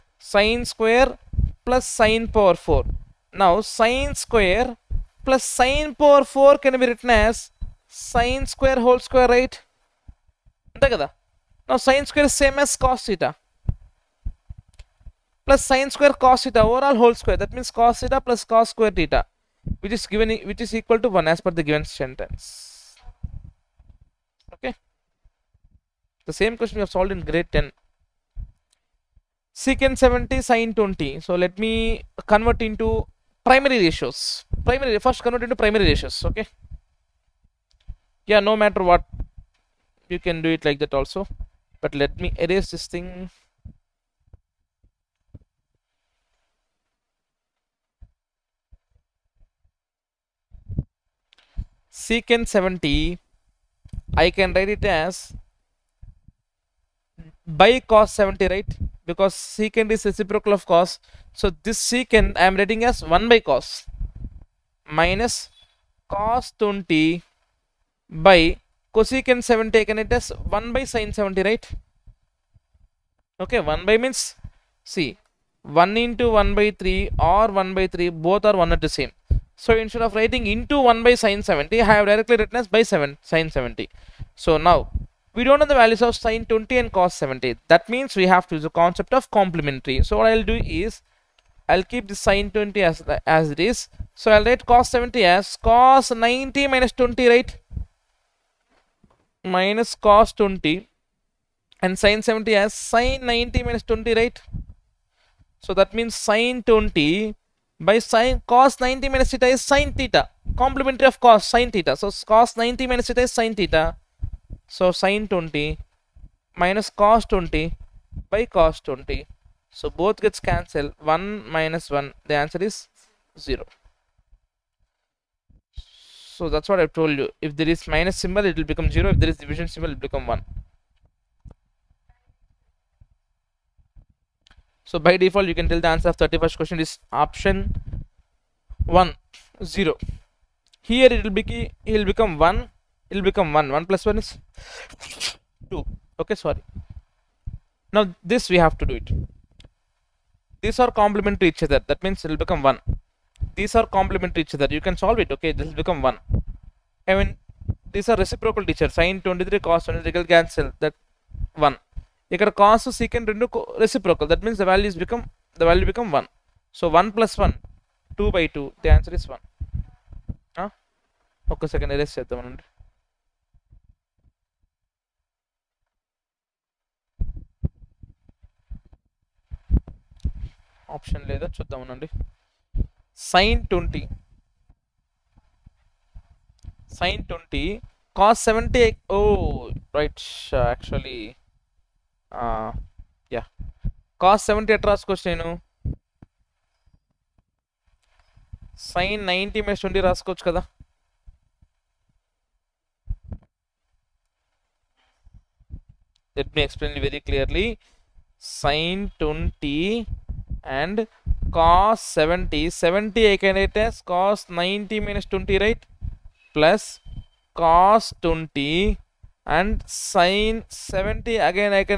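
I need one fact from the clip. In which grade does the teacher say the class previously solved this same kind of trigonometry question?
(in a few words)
Grade 10.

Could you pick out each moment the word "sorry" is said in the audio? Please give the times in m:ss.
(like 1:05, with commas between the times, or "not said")
2:26.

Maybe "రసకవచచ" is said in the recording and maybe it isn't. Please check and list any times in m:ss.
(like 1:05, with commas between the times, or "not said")
3:14, 3:20.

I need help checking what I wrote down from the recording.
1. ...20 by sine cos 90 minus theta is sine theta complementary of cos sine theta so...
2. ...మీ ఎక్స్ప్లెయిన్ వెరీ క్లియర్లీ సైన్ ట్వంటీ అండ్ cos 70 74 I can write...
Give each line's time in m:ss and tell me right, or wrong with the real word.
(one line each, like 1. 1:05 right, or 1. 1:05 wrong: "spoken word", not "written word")
1. 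1:46 right
2. 3:26 wrong: "70", not "74".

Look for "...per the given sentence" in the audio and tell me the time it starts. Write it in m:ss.
0:21.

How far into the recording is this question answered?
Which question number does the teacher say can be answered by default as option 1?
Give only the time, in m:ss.
2:16.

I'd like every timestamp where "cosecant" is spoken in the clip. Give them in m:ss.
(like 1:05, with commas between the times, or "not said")
1:08.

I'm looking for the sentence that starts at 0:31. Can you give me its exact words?
So let me convert into primary ratios.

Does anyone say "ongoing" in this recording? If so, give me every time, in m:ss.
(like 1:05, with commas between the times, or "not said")
not said.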